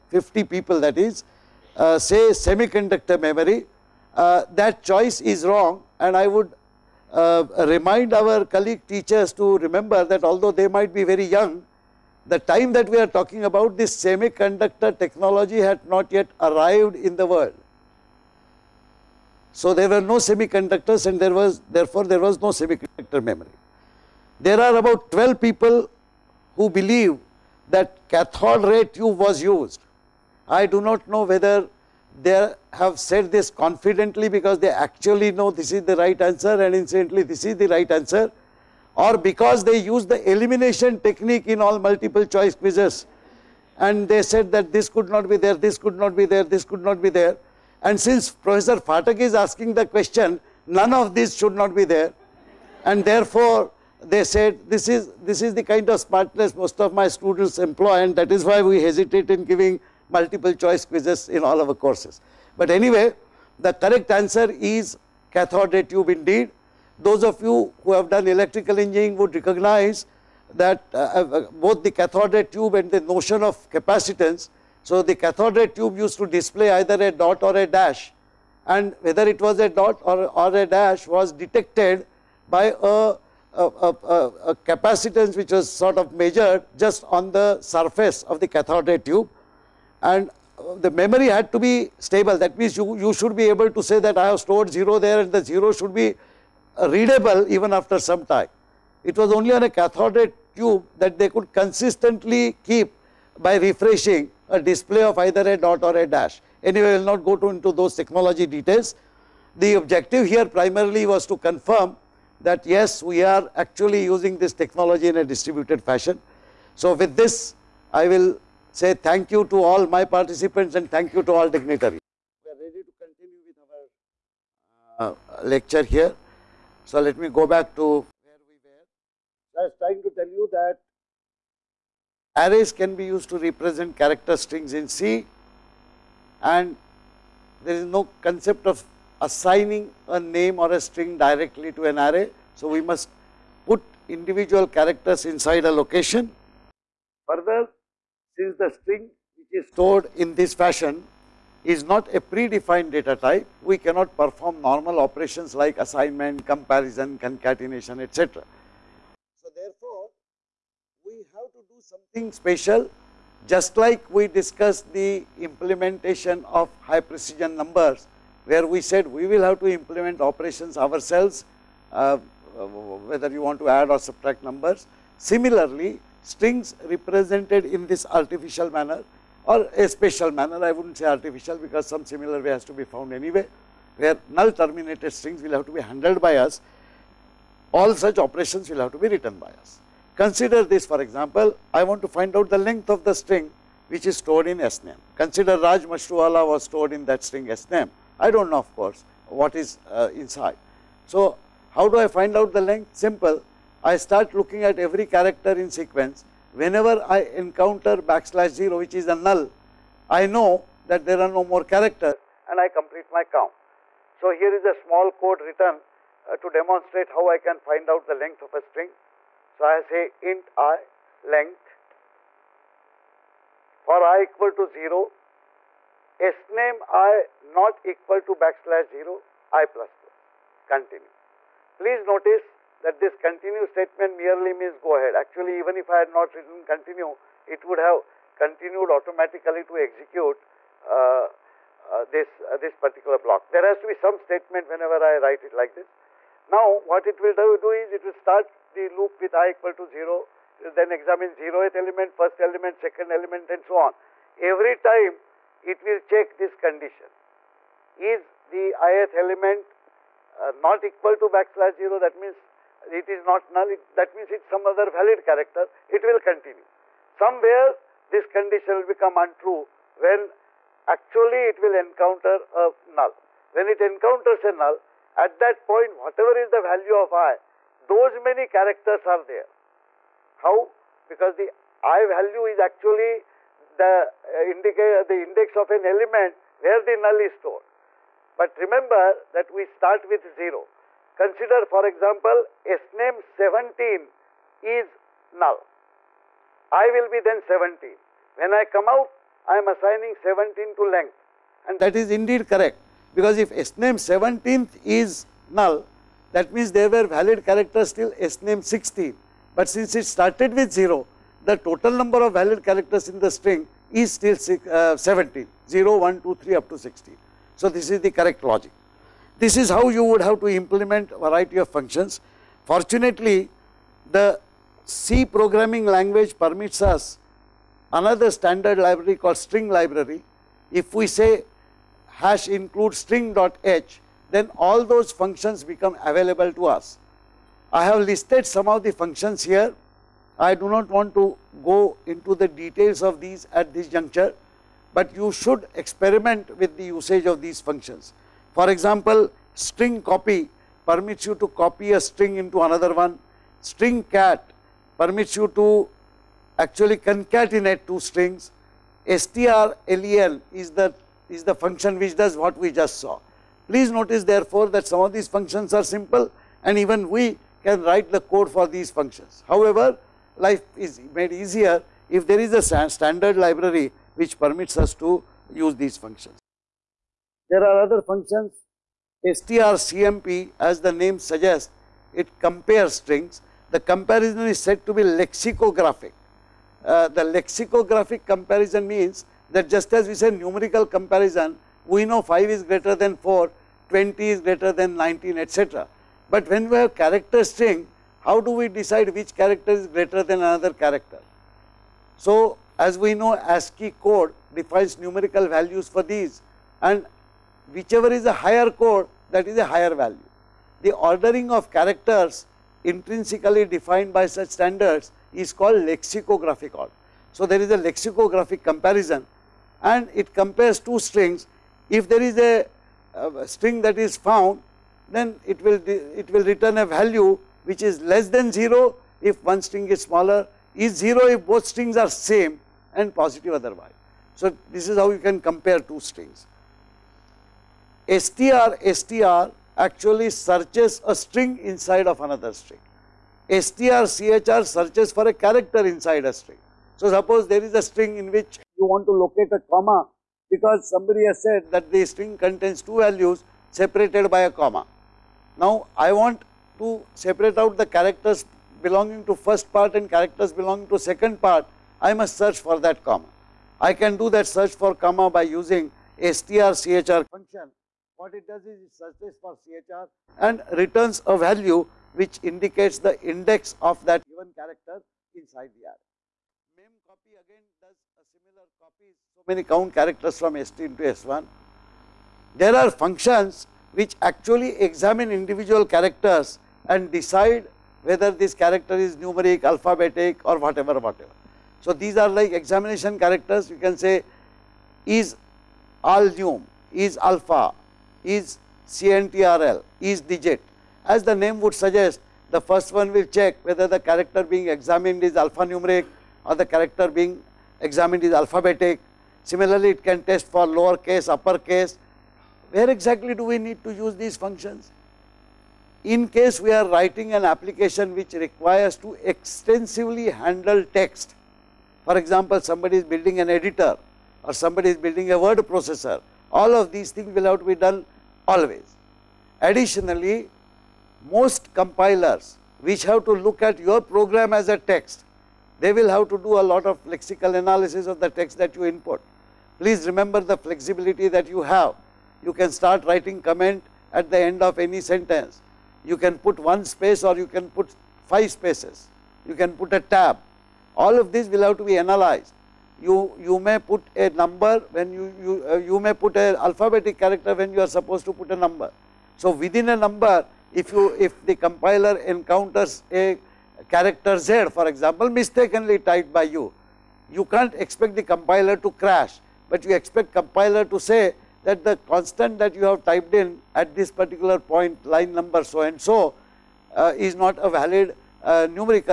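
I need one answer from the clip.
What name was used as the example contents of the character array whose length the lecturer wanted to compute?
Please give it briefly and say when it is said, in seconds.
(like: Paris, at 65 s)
Raj Mashruwala, at 195 s.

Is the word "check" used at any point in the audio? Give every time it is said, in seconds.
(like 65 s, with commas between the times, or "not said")
255 s, 503 s.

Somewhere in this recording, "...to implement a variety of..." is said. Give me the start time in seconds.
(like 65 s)
320 s.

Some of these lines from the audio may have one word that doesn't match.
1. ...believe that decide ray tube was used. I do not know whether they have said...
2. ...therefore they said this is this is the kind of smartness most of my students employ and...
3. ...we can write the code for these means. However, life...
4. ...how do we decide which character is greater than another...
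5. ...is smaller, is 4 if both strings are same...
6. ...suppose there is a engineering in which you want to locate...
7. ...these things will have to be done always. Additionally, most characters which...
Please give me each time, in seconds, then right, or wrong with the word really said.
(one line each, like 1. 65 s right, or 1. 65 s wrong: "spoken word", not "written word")
1. 26 s wrong: "cathode", not "decide"
2. 53 s right
3. 367 s wrong: "functions", not "means"
4. 398 s right
5. 429 s wrong: "0", not "4"
6. 447 s wrong: "string", not "engineering"
7. 526 s wrong: "compilers", not "characters".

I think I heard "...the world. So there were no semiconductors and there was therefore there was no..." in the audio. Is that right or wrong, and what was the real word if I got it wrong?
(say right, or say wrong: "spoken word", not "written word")
right.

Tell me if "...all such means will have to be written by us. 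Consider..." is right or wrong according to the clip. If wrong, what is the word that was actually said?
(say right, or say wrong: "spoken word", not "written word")
wrong: "operations", not "means".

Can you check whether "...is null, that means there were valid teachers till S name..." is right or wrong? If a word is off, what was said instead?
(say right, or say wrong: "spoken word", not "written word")
wrong: "characters", not "teachers".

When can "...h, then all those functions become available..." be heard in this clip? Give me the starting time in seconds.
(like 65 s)
333 s.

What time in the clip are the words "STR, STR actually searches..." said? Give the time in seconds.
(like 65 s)
438 s.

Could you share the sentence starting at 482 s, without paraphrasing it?
There are functions which actually examine individual characters and decide whether this character is numeric, alphabetic or whatever, whatever.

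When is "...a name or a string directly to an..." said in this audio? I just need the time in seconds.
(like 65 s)
140 s.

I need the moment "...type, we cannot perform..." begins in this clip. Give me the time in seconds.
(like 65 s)
153 s.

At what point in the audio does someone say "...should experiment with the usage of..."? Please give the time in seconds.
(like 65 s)
345 s.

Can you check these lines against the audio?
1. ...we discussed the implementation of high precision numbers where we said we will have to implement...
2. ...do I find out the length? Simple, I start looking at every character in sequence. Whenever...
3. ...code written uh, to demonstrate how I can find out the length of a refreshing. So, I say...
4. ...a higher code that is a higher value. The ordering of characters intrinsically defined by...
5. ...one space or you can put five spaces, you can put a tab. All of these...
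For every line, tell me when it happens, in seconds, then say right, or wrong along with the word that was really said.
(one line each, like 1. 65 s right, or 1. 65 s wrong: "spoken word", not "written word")
1. 164 s right
2. 201 s right
3. 215 s wrong: "string", not "refreshing"
4. 408 s right
5. 546 s right.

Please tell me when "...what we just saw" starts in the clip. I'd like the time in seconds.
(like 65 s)
362 s.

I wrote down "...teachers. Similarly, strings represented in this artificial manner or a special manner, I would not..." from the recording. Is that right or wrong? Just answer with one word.
wrong.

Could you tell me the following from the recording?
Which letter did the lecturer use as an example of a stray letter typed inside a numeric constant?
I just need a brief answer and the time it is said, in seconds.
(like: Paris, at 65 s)
Z, at 564 s.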